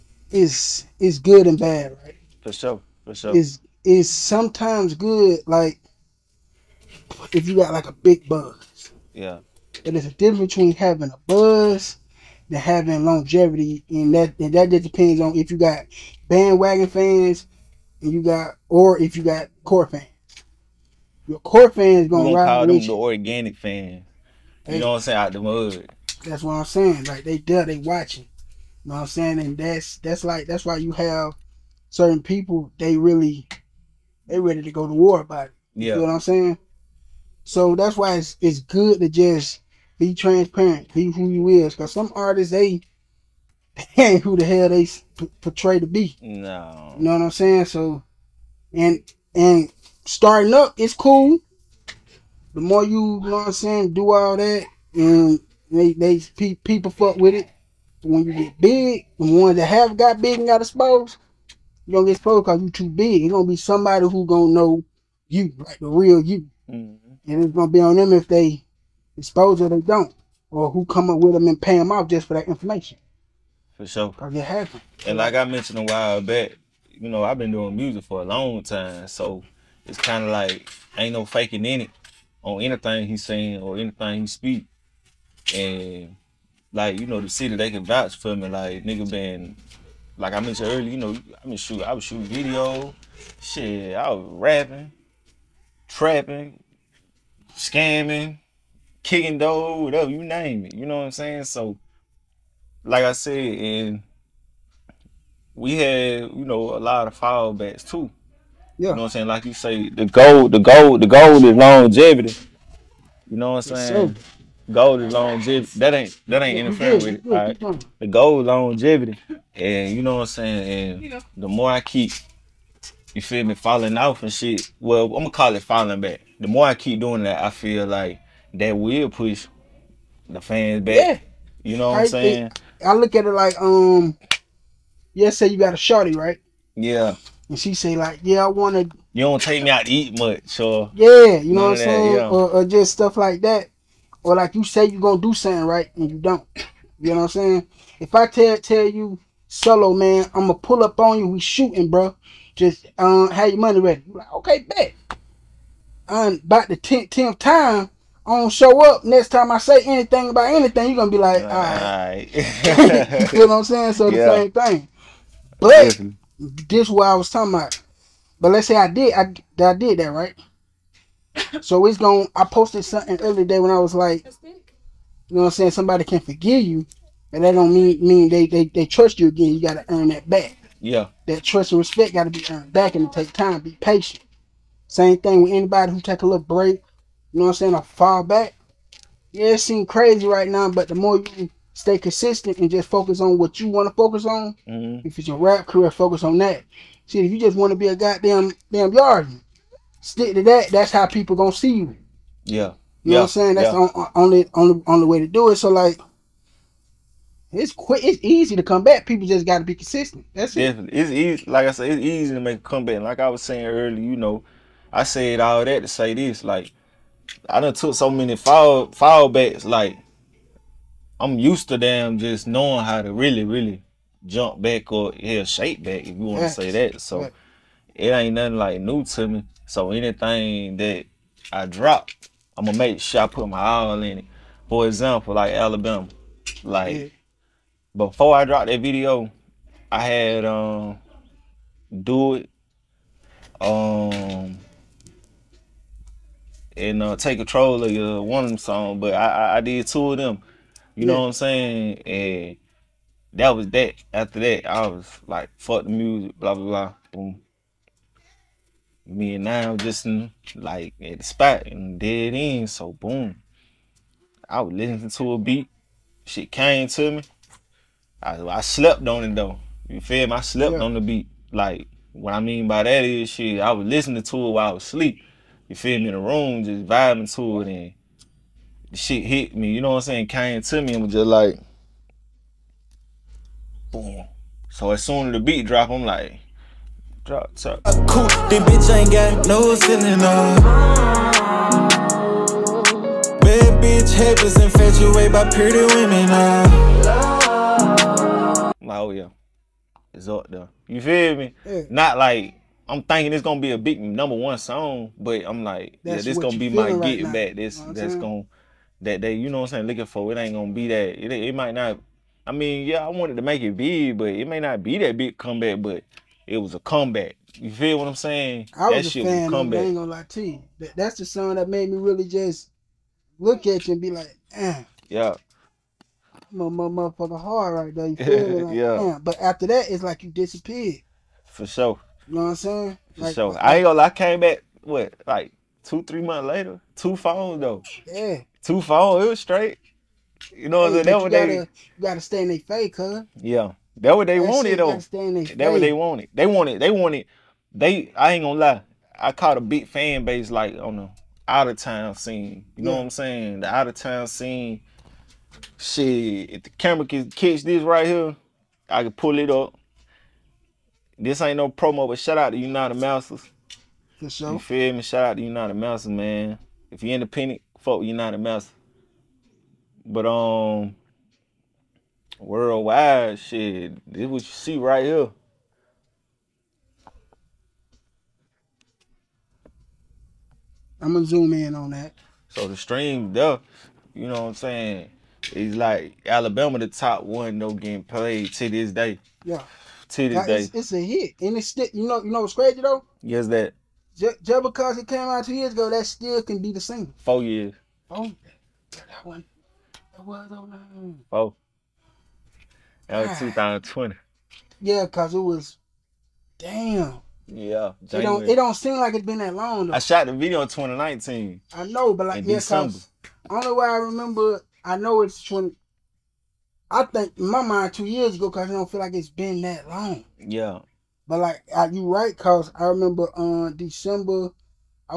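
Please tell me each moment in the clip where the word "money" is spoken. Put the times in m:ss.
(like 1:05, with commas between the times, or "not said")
2:33.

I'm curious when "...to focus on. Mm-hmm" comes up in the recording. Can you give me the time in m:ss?
3:13.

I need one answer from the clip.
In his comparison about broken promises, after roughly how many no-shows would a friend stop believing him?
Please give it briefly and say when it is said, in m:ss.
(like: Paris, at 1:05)
10, at 2:37.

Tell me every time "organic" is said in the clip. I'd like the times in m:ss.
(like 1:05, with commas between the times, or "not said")
0:22.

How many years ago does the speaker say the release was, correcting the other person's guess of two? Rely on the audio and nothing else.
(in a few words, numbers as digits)
4.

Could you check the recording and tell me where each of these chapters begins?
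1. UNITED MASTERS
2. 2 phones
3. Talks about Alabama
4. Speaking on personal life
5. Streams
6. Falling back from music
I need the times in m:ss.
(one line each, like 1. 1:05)
1. 6:02
2. 5:32
3. 3:52
4. 1:12
5. 6:12
6. 2:02.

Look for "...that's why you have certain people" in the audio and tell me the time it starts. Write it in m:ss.
0:30.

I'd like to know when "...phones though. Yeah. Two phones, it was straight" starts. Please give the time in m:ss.
5:37.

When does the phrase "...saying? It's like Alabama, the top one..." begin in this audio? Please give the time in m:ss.
6:24.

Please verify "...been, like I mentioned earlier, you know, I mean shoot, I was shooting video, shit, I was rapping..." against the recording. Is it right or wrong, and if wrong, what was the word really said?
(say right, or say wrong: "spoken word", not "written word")
right.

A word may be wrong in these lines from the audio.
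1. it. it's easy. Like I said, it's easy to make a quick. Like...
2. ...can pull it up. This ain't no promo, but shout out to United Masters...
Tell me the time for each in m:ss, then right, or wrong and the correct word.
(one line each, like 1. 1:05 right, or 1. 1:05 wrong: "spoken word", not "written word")
1. 3:30 wrong: "comeback", not "quick"
2. 5:59 right.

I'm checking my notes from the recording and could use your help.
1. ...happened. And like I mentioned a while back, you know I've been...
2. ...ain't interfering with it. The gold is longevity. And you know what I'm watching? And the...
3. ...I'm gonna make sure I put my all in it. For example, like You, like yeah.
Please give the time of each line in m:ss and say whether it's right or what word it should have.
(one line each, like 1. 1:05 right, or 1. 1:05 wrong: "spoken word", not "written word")
1. 1:14 right
2. 1:56 wrong: "saying", not "watching"
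3. 3:52 wrong: "Alabama", not "You".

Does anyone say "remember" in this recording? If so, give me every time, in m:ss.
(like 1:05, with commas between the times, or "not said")
6:53, 7:02.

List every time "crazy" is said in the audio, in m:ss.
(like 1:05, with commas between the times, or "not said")
3:09, 6:32.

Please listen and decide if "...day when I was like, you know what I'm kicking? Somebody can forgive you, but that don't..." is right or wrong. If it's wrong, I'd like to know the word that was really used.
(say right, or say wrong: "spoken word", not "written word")
wrong: "saying", not "kicking".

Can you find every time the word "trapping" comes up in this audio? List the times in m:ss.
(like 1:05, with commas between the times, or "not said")
1:35.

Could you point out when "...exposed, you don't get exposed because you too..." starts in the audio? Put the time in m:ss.
1:00.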